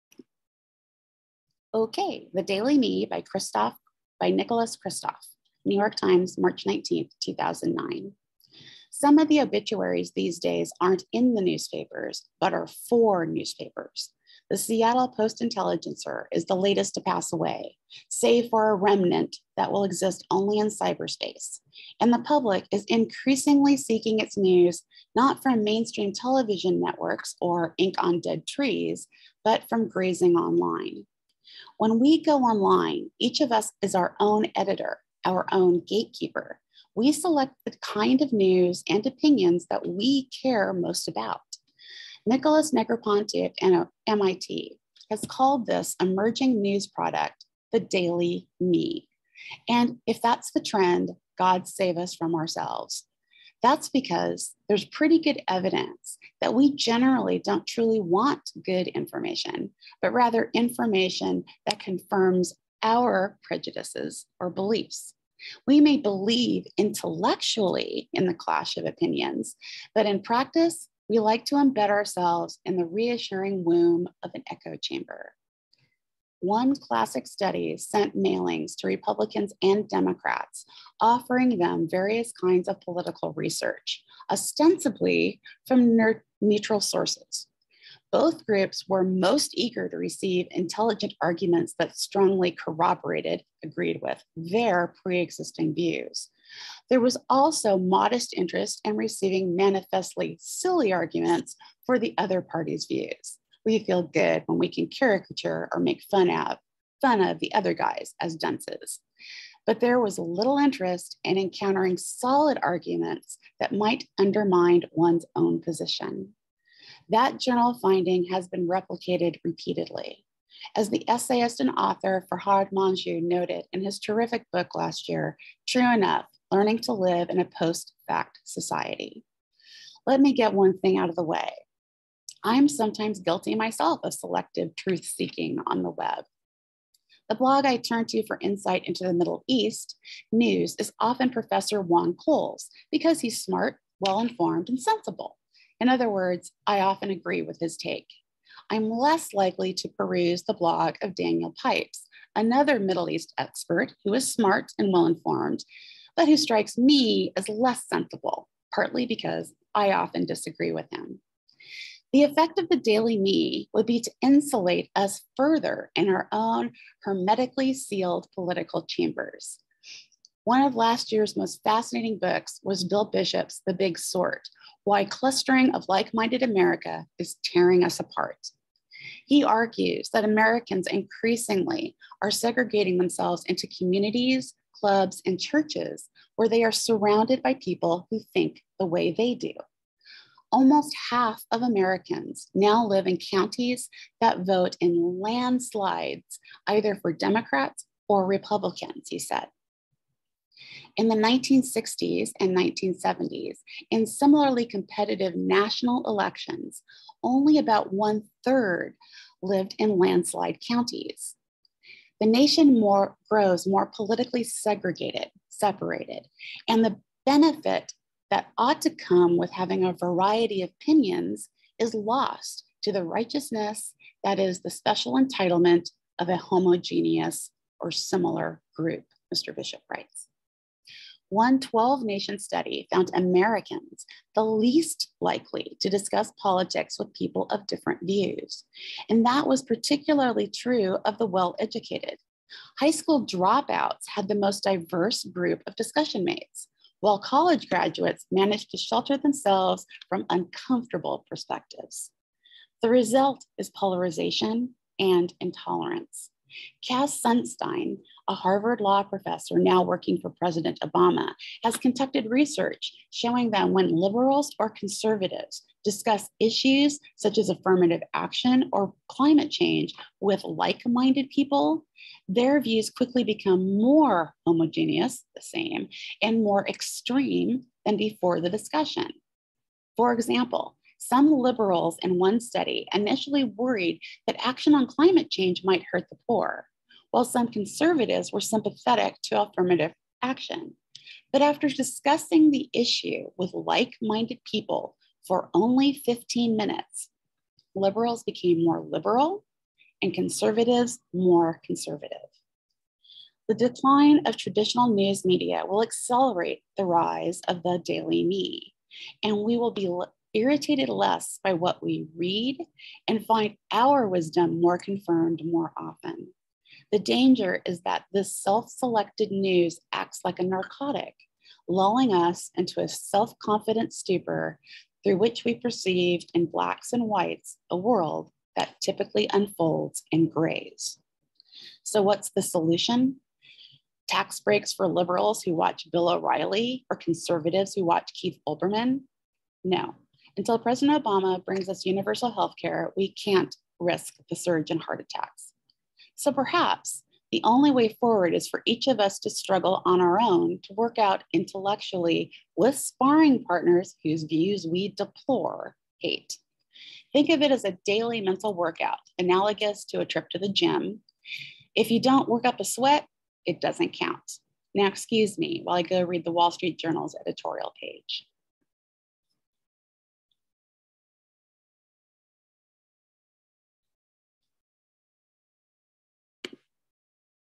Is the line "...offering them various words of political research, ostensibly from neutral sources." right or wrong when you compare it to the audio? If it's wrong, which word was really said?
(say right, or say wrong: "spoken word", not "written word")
wrong: "kinds", not "words".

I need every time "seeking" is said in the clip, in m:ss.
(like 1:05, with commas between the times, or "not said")
0:23, 2:15.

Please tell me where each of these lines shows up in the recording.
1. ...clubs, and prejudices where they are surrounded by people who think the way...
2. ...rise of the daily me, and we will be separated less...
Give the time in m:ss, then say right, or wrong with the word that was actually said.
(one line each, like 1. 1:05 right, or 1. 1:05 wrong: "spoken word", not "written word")
1. 3:04 wrong: "churches", not "prejudices"
2. 5:06 wrong: "irritated", not "separated".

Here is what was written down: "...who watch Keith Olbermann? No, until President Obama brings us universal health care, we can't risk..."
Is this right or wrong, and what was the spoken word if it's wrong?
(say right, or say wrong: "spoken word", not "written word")
right.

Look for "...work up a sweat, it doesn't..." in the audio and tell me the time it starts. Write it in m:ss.
6:02.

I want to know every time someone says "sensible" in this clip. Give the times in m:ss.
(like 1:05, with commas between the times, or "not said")
2:24, 2:37.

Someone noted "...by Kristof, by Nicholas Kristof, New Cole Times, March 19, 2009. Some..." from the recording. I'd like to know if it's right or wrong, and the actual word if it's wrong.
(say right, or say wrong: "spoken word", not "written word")
wrong: "York", not "Cole".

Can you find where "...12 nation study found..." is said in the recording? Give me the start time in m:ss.
3:51.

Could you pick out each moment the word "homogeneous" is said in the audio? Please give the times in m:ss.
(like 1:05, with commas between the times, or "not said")
3:46, 4:34.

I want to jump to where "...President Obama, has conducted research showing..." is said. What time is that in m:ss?
4:20.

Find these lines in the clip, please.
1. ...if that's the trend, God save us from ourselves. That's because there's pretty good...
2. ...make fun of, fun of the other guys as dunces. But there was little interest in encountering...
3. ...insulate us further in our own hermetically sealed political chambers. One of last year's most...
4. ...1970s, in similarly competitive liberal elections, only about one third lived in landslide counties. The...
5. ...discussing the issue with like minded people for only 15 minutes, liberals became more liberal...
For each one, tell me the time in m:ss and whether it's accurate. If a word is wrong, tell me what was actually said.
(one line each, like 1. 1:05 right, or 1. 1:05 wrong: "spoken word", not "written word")
1. 0:50 right
2. 1:45 right
3. 2:44 right
4. 3:22 wrong: "national", not "liberal"
5. 4:51 right.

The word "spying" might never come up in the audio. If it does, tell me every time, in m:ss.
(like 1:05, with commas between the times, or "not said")
not said.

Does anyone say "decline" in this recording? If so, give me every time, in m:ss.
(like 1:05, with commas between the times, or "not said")
5:03.